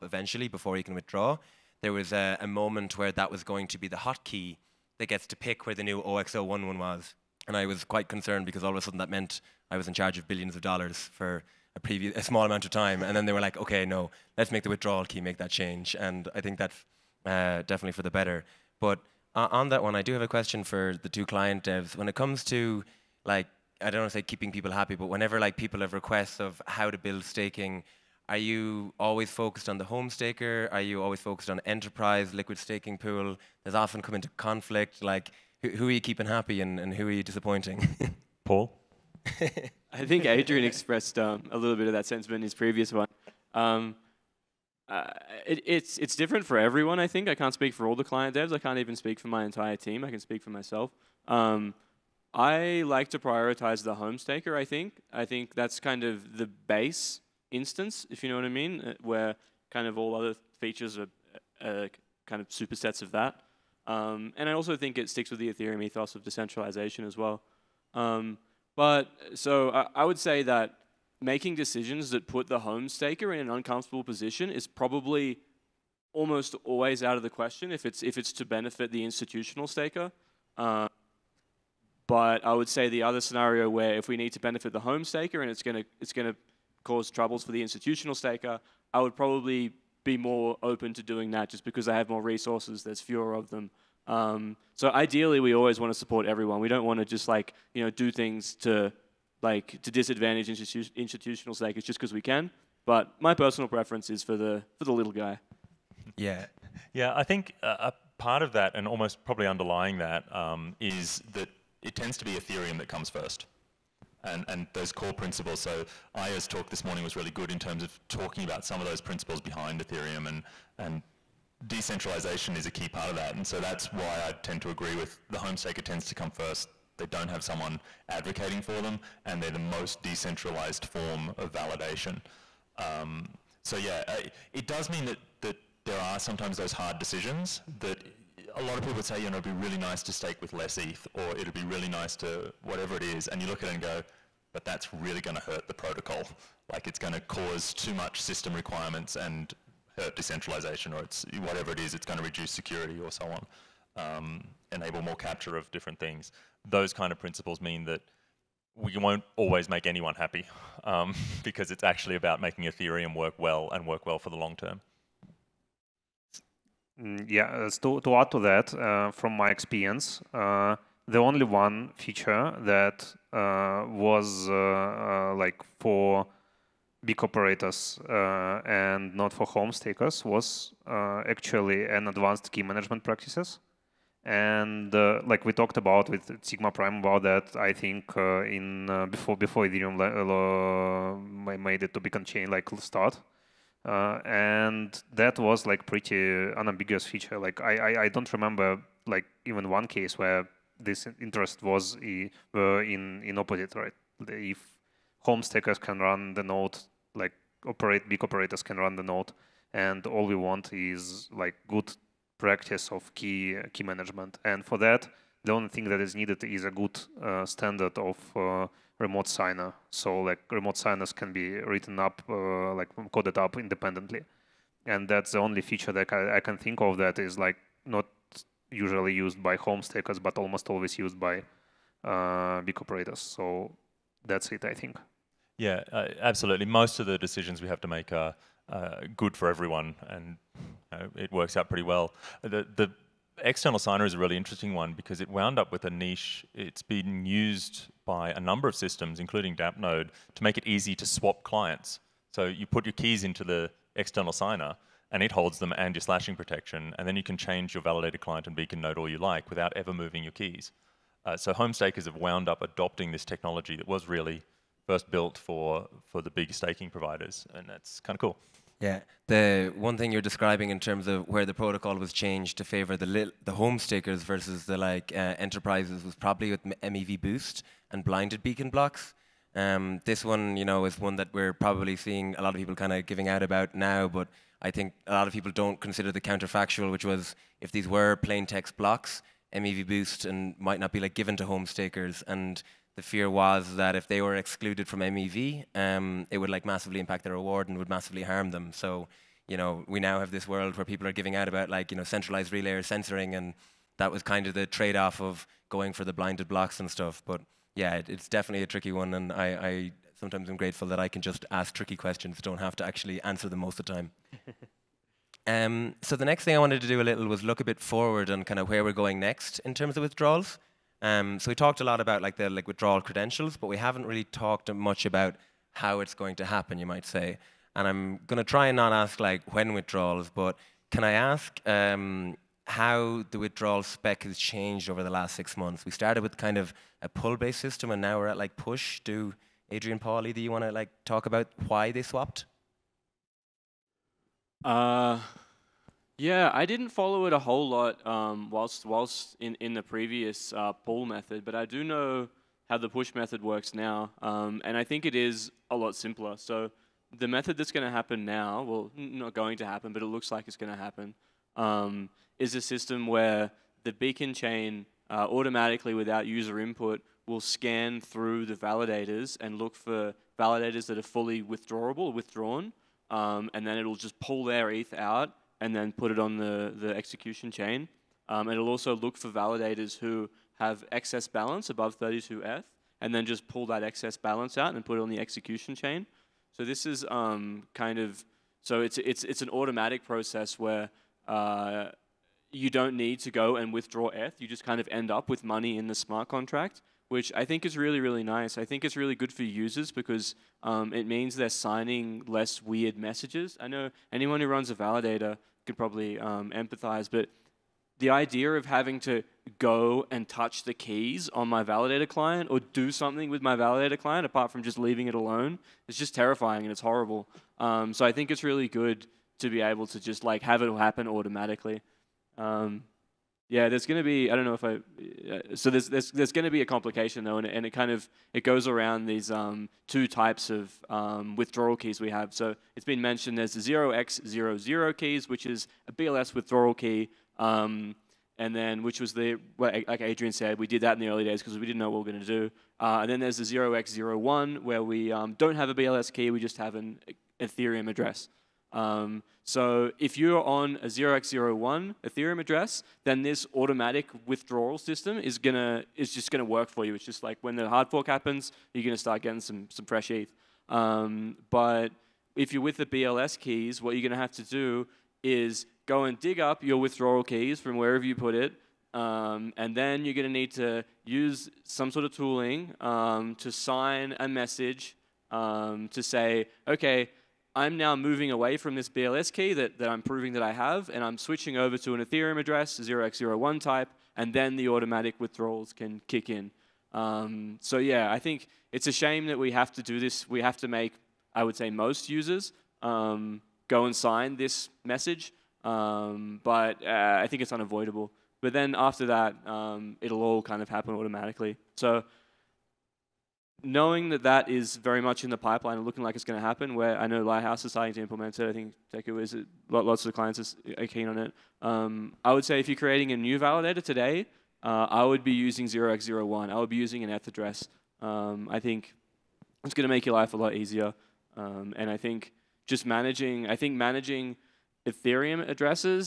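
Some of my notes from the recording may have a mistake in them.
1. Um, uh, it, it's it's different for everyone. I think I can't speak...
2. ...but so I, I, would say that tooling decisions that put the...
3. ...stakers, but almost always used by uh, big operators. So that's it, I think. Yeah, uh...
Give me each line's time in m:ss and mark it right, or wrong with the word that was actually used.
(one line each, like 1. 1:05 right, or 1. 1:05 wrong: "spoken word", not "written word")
1. 0:43 right
2. 1:08 wrong: "making", not "tooling"
3. 3:49 right.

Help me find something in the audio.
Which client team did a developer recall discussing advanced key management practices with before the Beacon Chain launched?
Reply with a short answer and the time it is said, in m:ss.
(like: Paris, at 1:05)
Sigma Prime, at 3:06.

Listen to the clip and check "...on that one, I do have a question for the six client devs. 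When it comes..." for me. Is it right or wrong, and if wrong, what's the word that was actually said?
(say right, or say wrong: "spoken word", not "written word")
wrong: "two", not "six".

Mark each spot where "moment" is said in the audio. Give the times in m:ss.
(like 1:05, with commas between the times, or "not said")
0:02.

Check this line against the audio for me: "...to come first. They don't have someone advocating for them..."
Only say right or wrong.
right.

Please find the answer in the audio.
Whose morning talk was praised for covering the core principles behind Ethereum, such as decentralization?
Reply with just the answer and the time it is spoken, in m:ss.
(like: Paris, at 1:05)
Aya, at 1:56.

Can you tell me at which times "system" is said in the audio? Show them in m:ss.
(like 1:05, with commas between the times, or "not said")
2:28, 4:08, 5:37, 6:02, 7:34.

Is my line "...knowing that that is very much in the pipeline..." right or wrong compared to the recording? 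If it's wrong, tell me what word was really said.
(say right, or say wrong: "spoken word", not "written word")
right.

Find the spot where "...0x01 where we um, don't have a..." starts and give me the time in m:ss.
7:23.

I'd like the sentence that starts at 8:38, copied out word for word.
Um, I think it's going to make your life a lot easier.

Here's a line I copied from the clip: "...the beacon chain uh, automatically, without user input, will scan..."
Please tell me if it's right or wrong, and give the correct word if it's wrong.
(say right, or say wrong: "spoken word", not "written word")
right.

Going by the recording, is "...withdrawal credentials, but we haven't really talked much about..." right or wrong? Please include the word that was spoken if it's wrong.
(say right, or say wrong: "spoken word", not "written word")
right.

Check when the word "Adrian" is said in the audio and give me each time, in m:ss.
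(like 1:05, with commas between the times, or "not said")
0:40, 5:39, 7:19.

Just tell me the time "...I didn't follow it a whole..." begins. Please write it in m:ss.
5:46.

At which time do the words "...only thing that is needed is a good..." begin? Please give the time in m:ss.
3:35.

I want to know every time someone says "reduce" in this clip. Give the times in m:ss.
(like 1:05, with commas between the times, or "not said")
2:32.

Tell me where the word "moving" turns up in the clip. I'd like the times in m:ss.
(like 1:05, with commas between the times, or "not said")
4:19, 7:57.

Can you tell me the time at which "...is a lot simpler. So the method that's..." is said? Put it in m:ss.
5:55.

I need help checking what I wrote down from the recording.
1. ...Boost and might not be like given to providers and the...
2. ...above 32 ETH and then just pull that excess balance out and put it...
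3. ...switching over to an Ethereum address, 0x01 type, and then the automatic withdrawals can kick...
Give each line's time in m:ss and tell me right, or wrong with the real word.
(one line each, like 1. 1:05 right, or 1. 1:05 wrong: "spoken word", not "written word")
1. 4:49 wrong: "stakers", not "providers"
2. 6:21 right
3. 8:01 right.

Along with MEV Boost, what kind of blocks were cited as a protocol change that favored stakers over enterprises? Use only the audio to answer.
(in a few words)
blinded beacon blocks.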